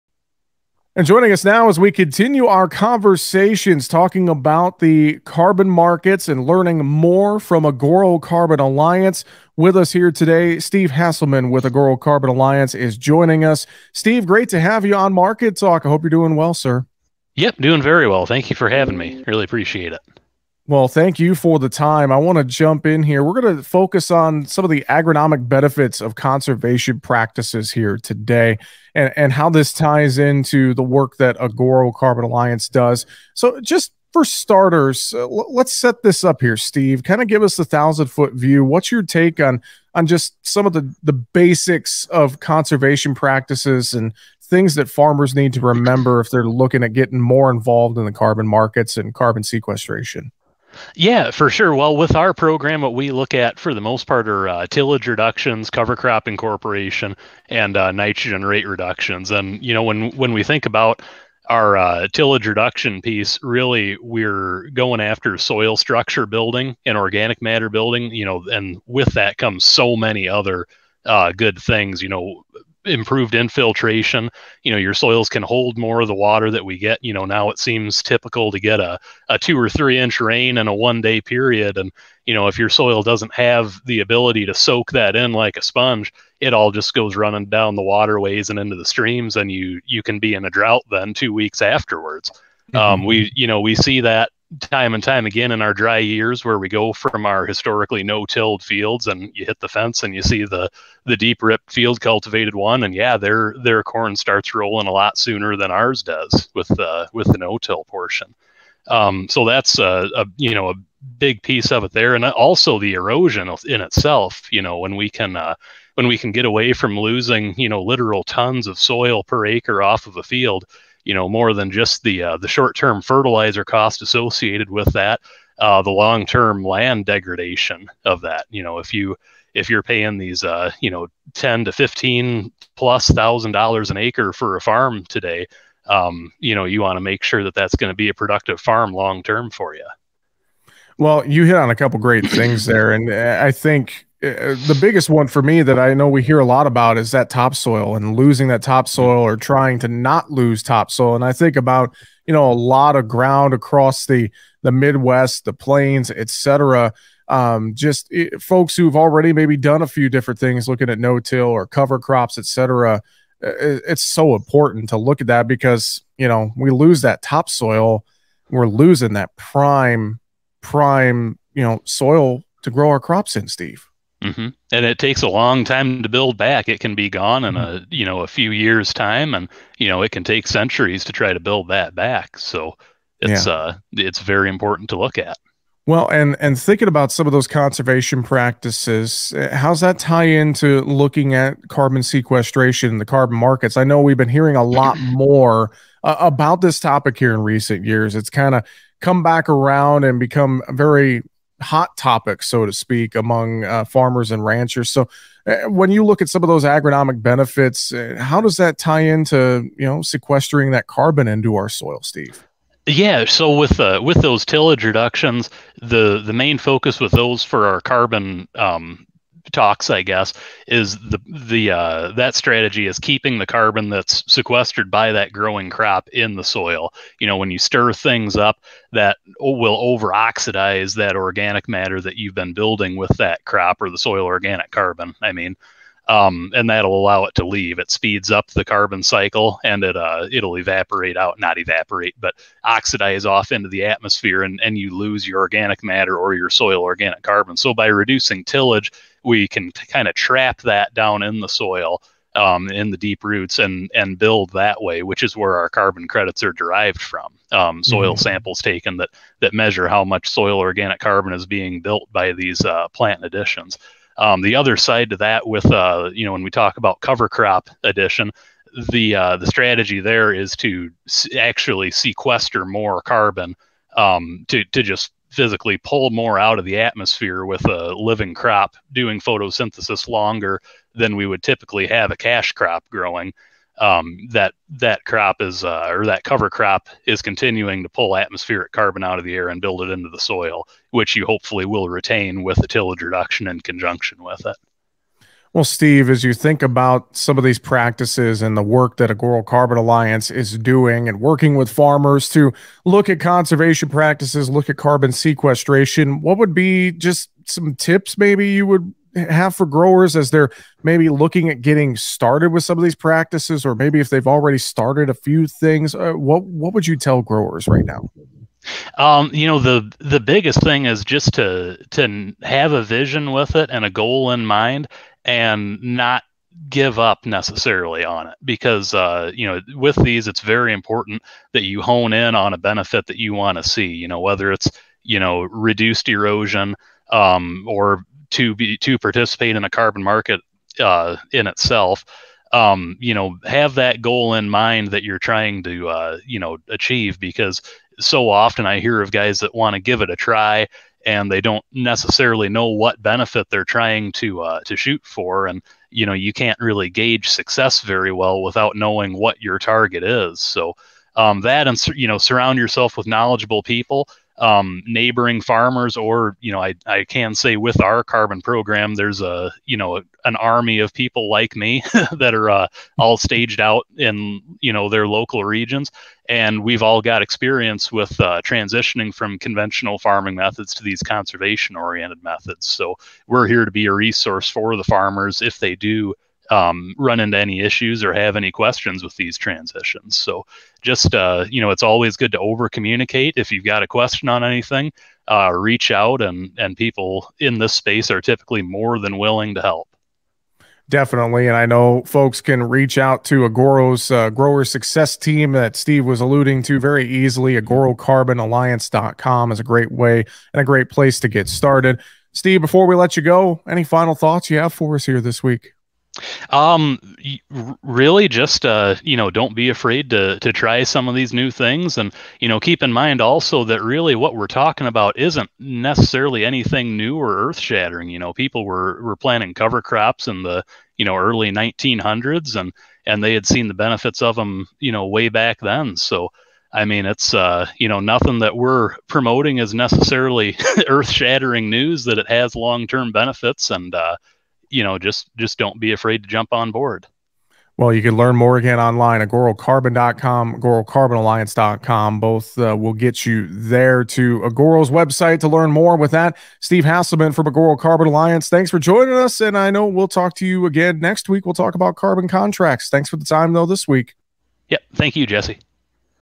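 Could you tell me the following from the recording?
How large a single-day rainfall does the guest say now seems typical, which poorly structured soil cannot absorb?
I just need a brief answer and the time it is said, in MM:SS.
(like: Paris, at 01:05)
2 or 3 inches, at 01:19.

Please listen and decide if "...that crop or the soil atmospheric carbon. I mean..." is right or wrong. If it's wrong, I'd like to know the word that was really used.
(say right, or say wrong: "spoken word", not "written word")
wrong: "organic", not "atmospheric".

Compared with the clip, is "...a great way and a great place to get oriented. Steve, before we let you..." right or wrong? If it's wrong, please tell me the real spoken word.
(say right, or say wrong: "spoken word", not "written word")
wrong: "started", not "oriented".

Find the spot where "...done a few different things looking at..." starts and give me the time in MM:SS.
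02:39.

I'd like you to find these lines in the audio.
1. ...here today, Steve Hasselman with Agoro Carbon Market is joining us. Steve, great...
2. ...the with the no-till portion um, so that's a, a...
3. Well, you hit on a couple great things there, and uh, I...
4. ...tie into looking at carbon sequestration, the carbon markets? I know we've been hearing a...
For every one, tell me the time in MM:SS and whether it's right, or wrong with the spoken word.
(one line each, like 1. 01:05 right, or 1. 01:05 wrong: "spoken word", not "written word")
1. 00:09 wrong: "Alliance", not "Market"
2. 01:46 right
3. 02:20 right
4. 03:09 right.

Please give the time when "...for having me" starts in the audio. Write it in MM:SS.
00:18.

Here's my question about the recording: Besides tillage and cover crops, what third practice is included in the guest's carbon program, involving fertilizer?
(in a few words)
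Nitrogen rate reductions.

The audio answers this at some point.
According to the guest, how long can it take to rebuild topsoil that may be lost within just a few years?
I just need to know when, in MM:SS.
03:00.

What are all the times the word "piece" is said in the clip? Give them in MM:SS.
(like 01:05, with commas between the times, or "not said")
01:03, 01:51.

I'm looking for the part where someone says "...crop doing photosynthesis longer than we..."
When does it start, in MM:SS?
04:38.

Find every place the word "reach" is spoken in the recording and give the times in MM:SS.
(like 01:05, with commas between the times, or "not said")
06:35, 06:42.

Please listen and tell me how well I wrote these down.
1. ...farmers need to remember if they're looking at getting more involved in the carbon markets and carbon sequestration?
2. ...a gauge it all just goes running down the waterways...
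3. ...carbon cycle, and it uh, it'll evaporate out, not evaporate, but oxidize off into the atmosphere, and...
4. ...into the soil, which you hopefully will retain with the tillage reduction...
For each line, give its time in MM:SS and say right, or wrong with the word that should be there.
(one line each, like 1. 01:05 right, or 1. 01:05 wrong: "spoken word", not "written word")
1. 00:44 right
2. 01:25 wrong: "sponge", not "gauge"
3. 03:58 right
4. 04:49 right.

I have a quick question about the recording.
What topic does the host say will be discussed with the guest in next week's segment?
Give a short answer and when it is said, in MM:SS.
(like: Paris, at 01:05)
Carbon contracts, at 07:41.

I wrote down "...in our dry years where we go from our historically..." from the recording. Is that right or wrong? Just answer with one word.
right.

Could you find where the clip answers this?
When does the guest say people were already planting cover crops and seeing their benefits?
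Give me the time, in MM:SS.
07:11.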